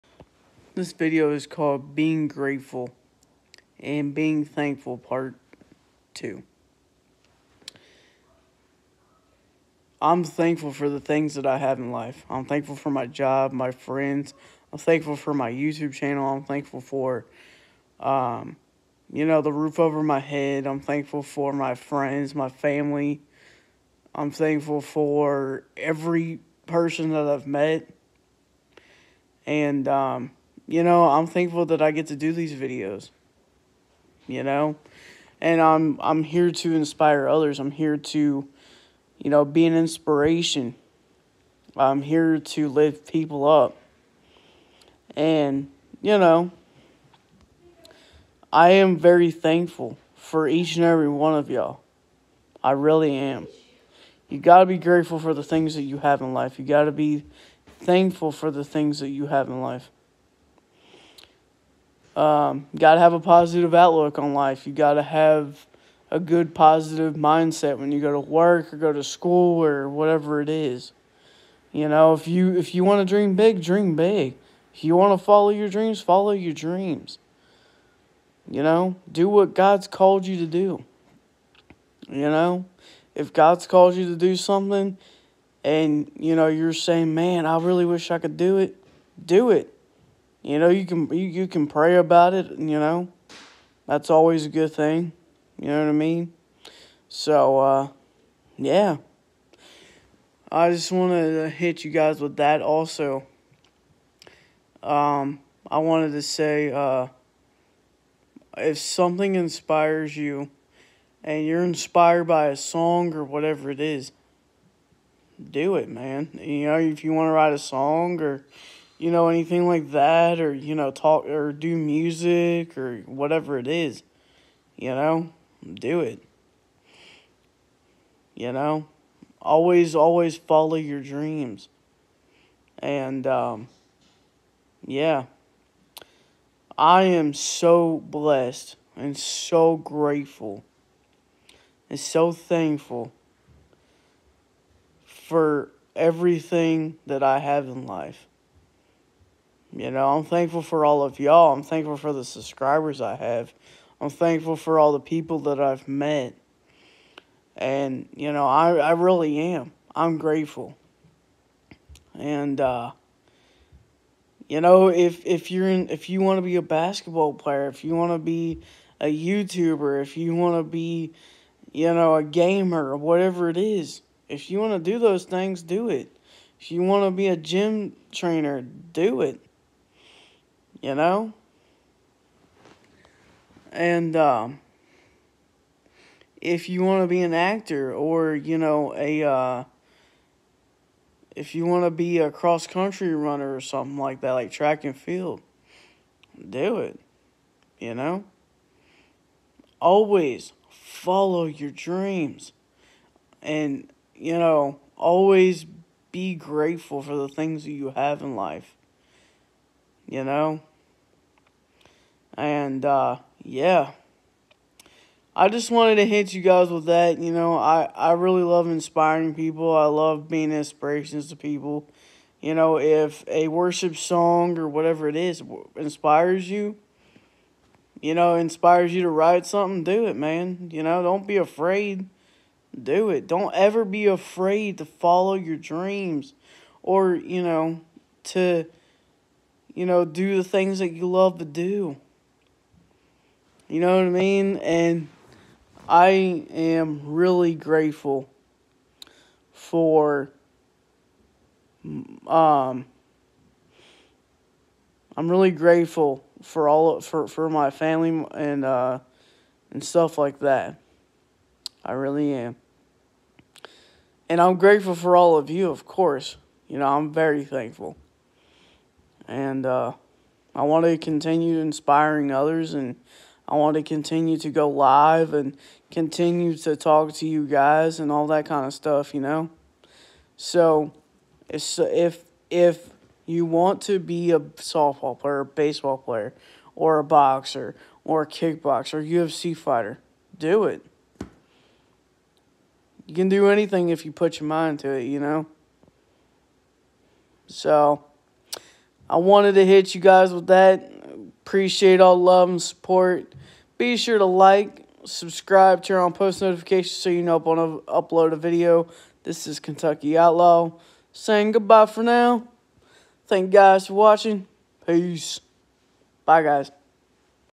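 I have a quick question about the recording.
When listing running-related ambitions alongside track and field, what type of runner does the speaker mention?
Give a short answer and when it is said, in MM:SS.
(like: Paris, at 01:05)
Cross country runner, at 03:12.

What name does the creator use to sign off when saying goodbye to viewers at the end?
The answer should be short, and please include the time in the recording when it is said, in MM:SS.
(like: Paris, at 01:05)
Kentucky Outlaw, at 05:09.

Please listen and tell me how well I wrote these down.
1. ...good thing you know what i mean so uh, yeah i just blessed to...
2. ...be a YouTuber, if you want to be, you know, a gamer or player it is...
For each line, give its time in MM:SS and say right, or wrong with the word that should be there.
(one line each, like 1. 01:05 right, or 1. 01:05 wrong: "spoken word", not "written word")
1. 01:34 wrong: "wanted", not "blessed"
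2. 02:48 wrong: "whatever", not "player".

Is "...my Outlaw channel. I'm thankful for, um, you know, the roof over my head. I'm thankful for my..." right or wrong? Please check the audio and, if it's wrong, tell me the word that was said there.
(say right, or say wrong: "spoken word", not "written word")
wrong: "YouTube", not "Outlaw".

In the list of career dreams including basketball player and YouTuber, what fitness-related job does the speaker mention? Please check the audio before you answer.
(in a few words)
Gym trainer.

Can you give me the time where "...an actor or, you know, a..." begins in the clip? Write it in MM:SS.
03:07.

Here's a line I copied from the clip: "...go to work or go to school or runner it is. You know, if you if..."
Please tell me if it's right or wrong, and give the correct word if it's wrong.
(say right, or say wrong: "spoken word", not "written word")
wrong: "whatever", not "runner".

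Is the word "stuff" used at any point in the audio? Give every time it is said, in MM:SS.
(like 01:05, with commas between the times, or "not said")
04:19, 04:38.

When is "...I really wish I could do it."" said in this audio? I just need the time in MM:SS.
01:27.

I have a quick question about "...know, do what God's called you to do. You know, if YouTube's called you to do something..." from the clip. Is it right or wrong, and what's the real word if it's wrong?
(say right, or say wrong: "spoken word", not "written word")
wrong: "God", not "YouTube".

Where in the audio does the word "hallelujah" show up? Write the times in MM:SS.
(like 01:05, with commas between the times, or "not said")
not said.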